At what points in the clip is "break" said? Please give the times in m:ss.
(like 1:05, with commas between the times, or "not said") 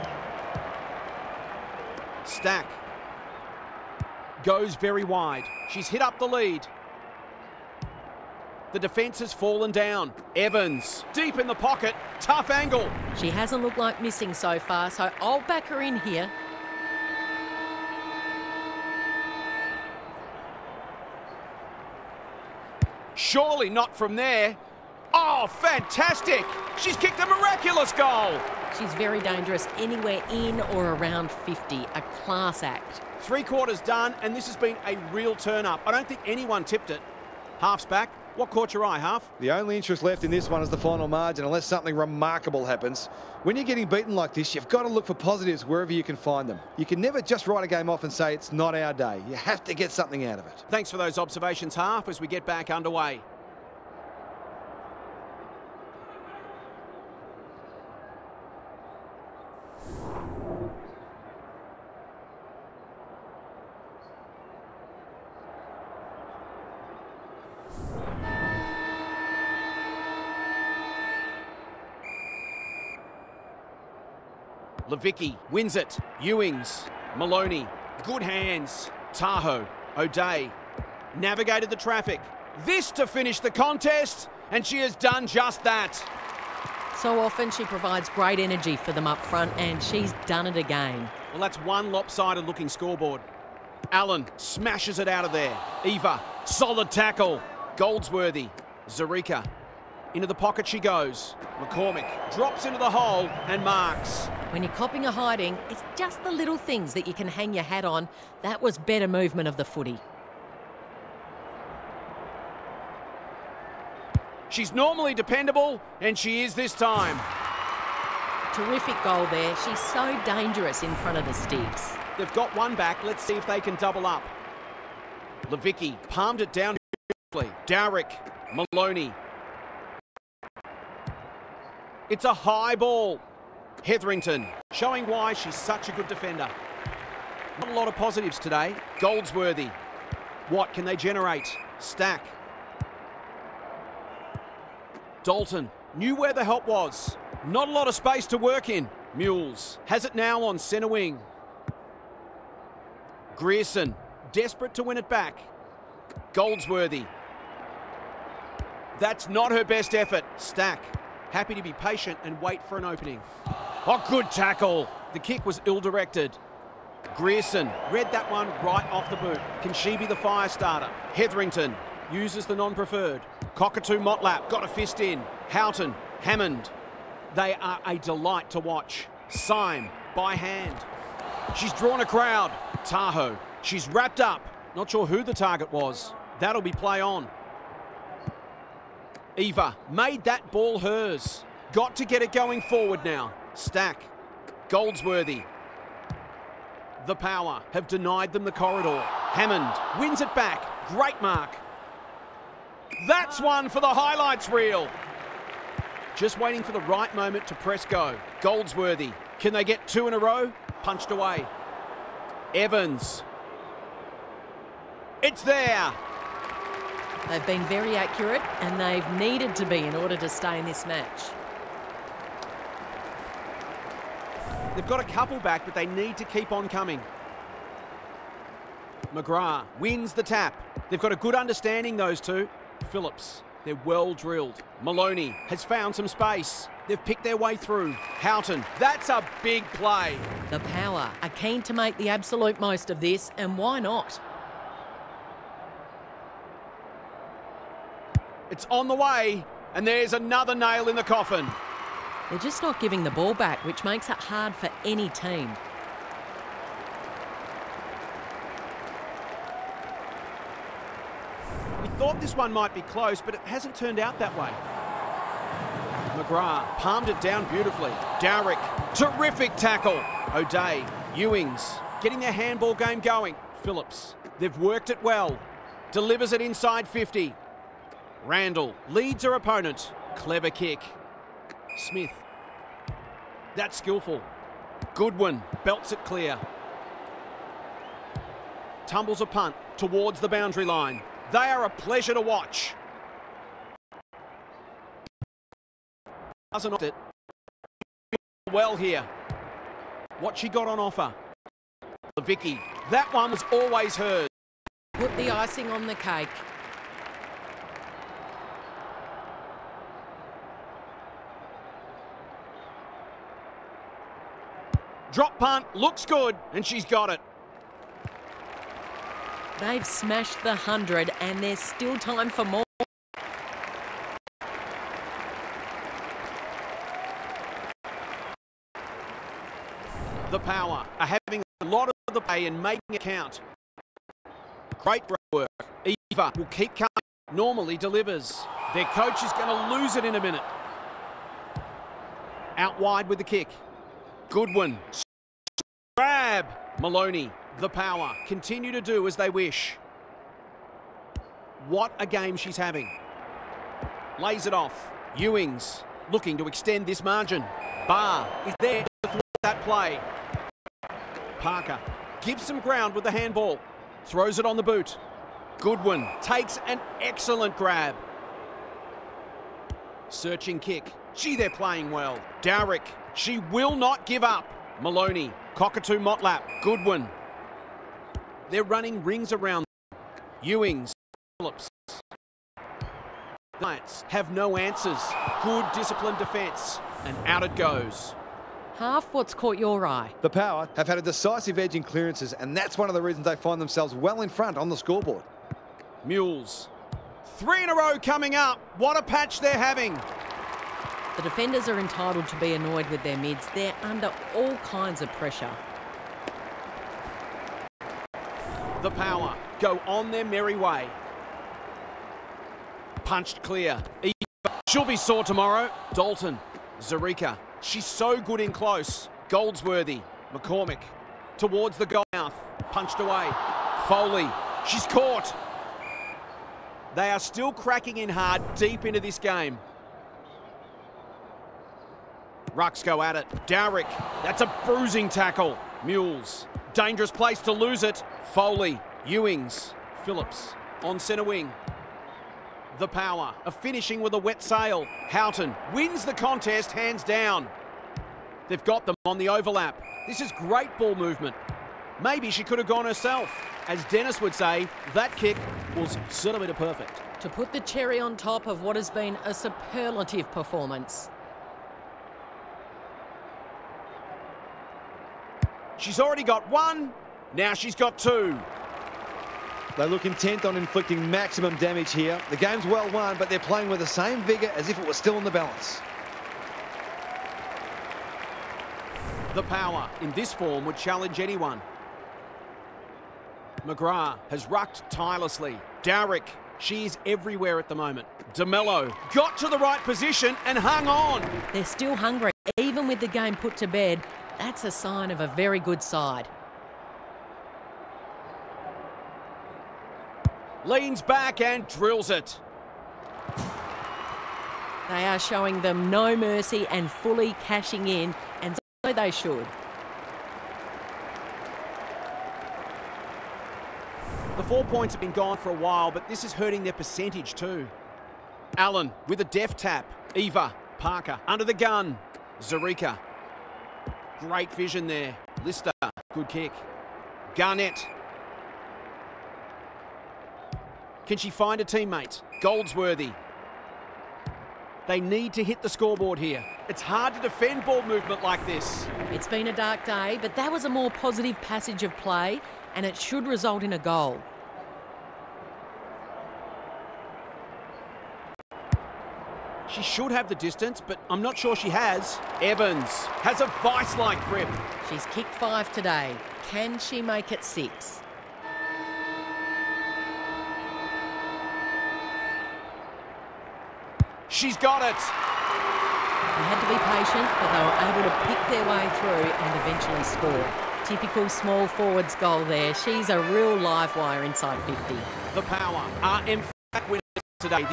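not said.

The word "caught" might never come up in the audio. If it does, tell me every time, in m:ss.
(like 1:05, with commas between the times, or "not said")
0:38, 6:29, 7:04.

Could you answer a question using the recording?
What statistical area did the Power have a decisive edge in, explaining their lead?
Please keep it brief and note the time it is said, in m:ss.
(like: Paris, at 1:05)
Clearances, at 6:31.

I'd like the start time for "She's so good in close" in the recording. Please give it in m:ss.
6:57.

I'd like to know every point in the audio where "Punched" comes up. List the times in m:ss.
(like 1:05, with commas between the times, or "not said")
3:30, 6:53, 7:02.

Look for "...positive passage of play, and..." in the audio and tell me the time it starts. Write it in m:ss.
9:00.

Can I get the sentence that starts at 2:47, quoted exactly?
Grierson read that one right off the boot.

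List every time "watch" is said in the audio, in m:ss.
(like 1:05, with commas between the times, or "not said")
2:58, 4:52.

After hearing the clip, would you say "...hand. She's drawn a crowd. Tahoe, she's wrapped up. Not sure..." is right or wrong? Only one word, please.
right.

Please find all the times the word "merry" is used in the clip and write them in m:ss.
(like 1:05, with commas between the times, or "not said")
6:50.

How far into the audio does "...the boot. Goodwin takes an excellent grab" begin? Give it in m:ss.
6:04.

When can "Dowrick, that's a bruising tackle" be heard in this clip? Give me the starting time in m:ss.
7:13.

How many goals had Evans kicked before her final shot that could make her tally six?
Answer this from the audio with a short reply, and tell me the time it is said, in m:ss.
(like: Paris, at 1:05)
5, at 9:15.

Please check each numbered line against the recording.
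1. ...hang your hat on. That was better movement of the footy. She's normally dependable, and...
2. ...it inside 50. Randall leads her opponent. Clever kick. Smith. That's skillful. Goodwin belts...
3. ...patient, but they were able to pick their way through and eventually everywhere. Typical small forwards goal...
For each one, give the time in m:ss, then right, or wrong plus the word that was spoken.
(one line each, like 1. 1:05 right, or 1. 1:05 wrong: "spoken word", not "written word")
1. 1:47 right
2. 4:36 right
3. 9:26 wrong: "score", not "everywhere".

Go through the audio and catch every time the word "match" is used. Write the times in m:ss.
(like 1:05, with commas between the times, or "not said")
3:40.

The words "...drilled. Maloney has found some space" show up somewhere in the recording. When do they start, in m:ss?
3:54.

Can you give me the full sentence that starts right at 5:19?
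They've smashed the 100 and there's still time for more.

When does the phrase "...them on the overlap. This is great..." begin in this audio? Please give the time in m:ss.
7:28.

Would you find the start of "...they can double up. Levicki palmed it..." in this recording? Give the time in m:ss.
2:03.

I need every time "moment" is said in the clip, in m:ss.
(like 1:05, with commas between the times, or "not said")
3:27, 8:07.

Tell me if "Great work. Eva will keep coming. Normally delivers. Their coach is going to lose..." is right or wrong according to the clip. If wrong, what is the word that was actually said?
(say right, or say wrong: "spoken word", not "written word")
right.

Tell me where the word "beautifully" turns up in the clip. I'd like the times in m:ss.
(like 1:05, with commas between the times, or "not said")
4:27.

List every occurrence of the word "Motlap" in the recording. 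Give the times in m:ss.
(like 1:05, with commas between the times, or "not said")
2:53, 6:15.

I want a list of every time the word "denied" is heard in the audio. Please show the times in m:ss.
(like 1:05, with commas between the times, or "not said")
3:17.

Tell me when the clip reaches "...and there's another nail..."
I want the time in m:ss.
4:09.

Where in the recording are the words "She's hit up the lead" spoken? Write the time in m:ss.
0:05.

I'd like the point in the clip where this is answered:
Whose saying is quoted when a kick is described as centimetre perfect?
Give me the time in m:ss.
7:33.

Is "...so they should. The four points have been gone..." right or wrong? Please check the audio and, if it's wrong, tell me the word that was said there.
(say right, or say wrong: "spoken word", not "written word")
right.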